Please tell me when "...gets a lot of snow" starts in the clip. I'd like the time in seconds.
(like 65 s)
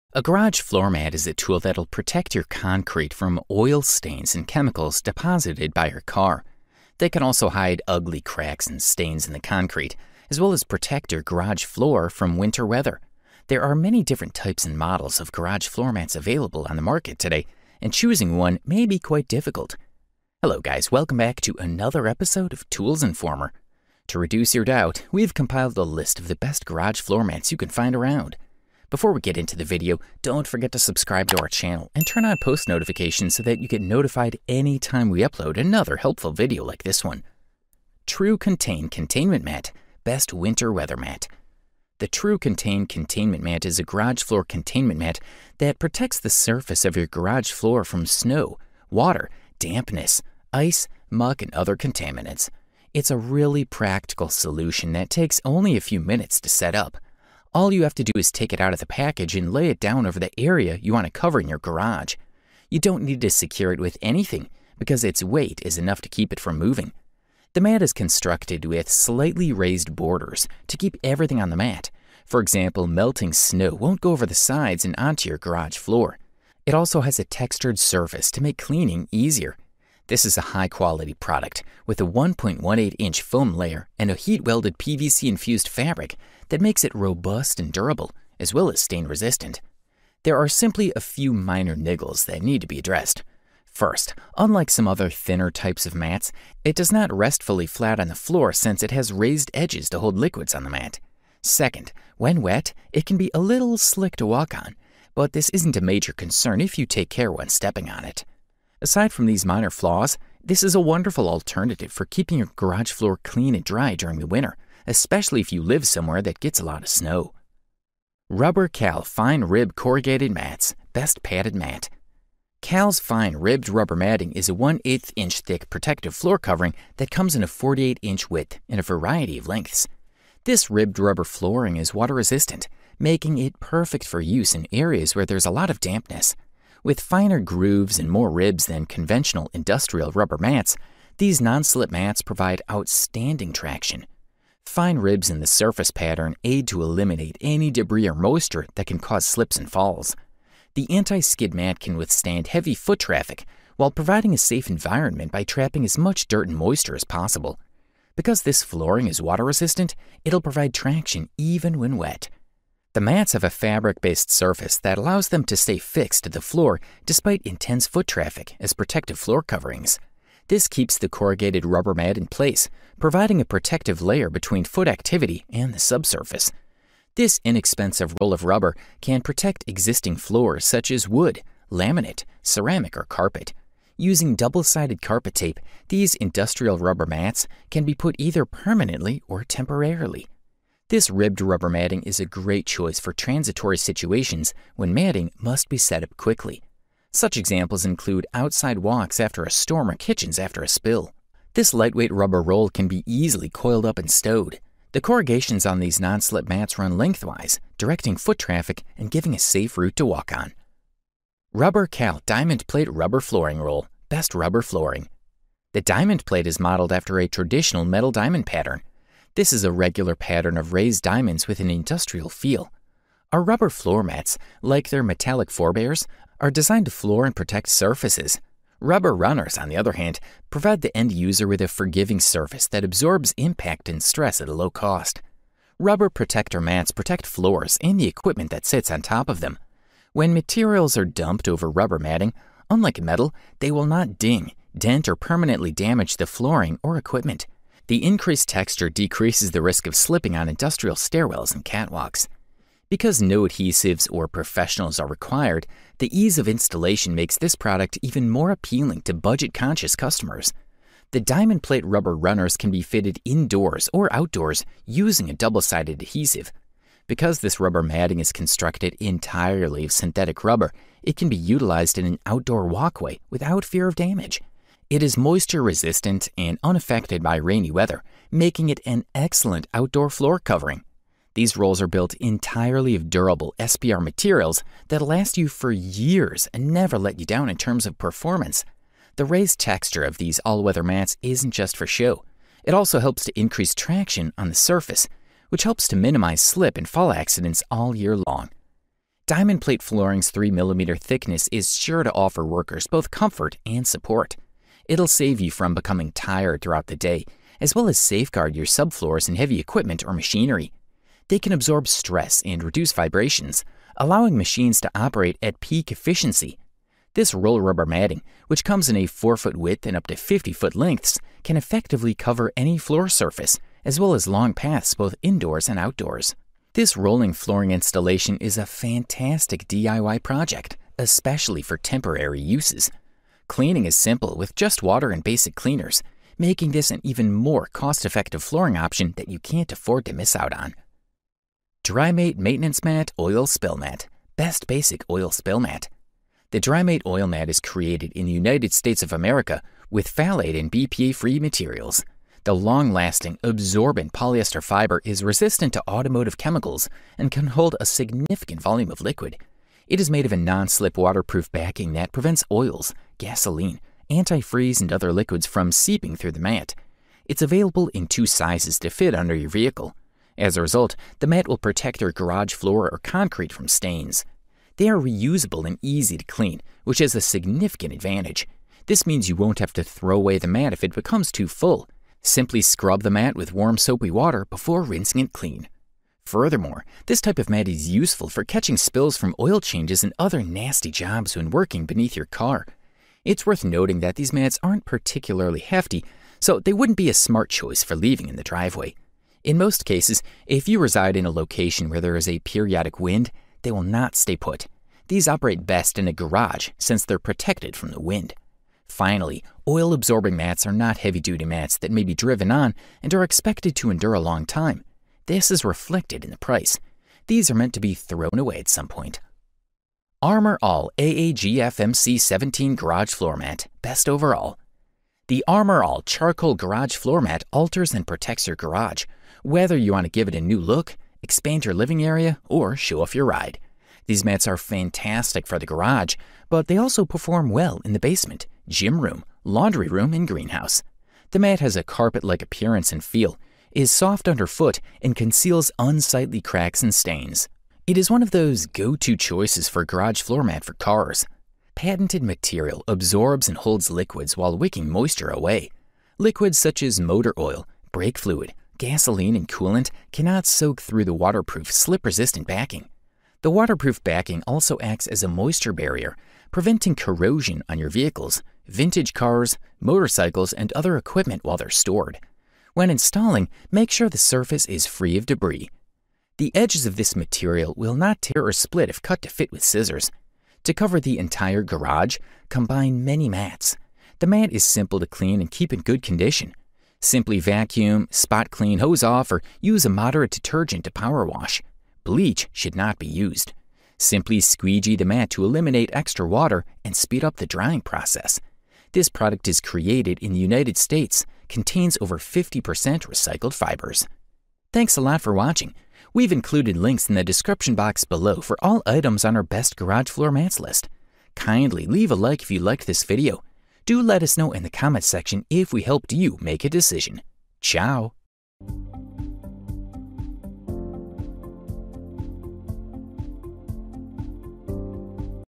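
116 s.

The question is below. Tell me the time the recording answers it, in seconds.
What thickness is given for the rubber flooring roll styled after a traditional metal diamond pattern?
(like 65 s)
300 s.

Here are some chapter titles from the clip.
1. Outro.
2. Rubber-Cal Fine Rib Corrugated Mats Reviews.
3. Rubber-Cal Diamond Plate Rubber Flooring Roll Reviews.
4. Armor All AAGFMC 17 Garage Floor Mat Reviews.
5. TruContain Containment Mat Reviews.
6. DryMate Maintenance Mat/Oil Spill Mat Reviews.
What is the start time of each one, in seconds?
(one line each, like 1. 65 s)
1. 504 s
2. 121 s
3. 213 s
4. 422 s
5. 40 s
6. 344 s.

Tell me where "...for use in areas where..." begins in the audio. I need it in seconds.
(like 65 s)
134 s.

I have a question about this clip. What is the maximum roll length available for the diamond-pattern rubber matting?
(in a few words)
50 foot.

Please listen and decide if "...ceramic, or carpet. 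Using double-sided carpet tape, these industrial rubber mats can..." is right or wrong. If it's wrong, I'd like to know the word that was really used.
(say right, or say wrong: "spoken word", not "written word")
right.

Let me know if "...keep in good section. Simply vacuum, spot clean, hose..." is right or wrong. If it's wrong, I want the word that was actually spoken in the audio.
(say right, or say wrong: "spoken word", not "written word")
wrong: "condition", not "section".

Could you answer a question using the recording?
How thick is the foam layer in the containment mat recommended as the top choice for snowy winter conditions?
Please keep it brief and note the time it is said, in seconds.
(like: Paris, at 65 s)
1.18 inch, at 82 s.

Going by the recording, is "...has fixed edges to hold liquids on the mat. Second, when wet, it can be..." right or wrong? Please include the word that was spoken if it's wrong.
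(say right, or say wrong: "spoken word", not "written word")
wrong: "raised", not "fixed".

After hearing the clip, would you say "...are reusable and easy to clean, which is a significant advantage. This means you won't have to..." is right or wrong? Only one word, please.
right.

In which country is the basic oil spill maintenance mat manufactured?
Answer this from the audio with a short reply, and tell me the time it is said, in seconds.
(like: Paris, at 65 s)
United States of America, at 348 s.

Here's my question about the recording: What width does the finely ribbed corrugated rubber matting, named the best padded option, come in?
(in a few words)
48 inch.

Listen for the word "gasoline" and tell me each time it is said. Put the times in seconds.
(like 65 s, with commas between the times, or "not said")
363 s, 458 s.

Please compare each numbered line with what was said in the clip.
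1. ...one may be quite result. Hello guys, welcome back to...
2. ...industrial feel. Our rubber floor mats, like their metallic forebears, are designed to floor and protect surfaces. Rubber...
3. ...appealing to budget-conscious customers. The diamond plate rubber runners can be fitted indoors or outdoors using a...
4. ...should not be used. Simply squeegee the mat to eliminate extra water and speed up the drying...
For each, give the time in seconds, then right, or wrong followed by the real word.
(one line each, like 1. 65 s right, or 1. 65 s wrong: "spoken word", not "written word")
1. 18 s wrong: "difficult", not "result"
2. 221 s right
3. 258 s right
4. 492 s right.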